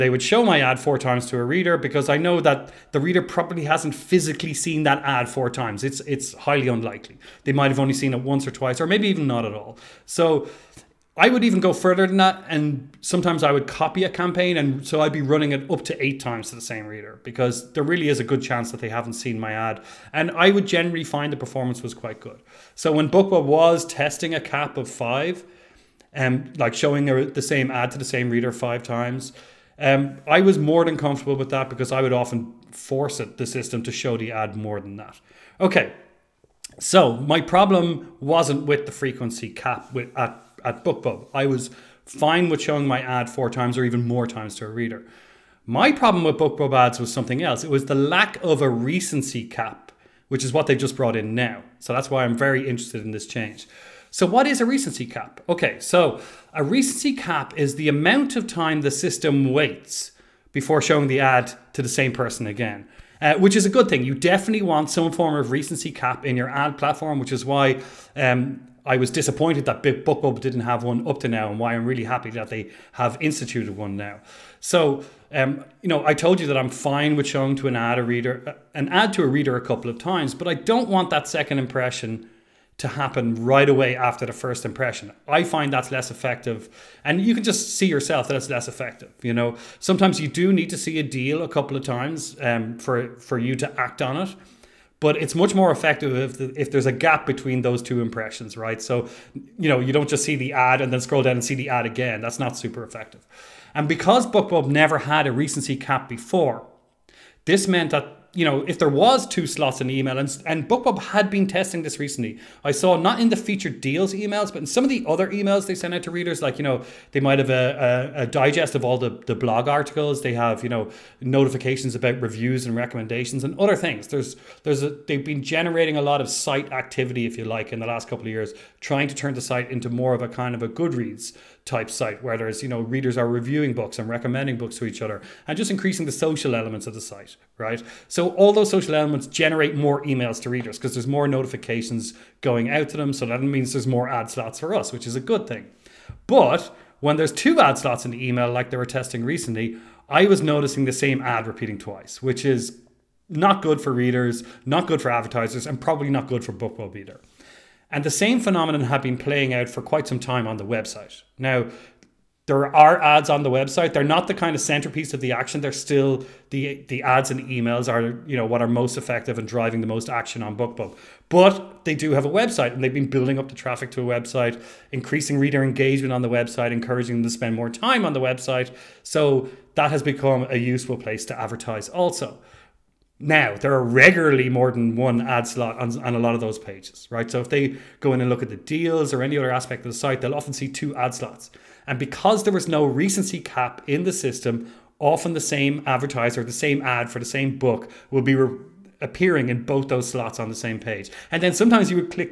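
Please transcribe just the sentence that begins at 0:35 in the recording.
Okay, so my problem wasn't with the frequency cap with, at, at BookBub.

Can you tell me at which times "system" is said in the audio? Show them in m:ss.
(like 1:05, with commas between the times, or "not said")
0:33, 0:58, 3:14.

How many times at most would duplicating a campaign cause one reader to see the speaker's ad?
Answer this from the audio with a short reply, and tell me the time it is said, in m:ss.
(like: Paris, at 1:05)
8, at 0:16.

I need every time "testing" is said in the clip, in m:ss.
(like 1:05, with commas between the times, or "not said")
0:23, 1:51, 2:28.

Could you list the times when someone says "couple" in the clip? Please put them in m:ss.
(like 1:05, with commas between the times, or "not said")
1:19, 1:31, 2:08.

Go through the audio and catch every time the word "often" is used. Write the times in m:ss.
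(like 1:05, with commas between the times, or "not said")
0:32, 3:10, 3:14.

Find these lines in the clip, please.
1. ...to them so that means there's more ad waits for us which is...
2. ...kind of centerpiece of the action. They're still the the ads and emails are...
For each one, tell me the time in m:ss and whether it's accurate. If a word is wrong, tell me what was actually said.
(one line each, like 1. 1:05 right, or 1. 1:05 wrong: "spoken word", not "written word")
1. 2:22 wrong: "slots", not "waits"
2. 2:44 right.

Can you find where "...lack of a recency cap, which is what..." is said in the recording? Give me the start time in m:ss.
0:47.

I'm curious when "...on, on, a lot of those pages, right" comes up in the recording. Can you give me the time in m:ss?
3:05.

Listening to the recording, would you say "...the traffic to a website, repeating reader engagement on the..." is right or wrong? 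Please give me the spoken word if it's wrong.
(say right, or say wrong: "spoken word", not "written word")
wrong: "increasing", not "repeating".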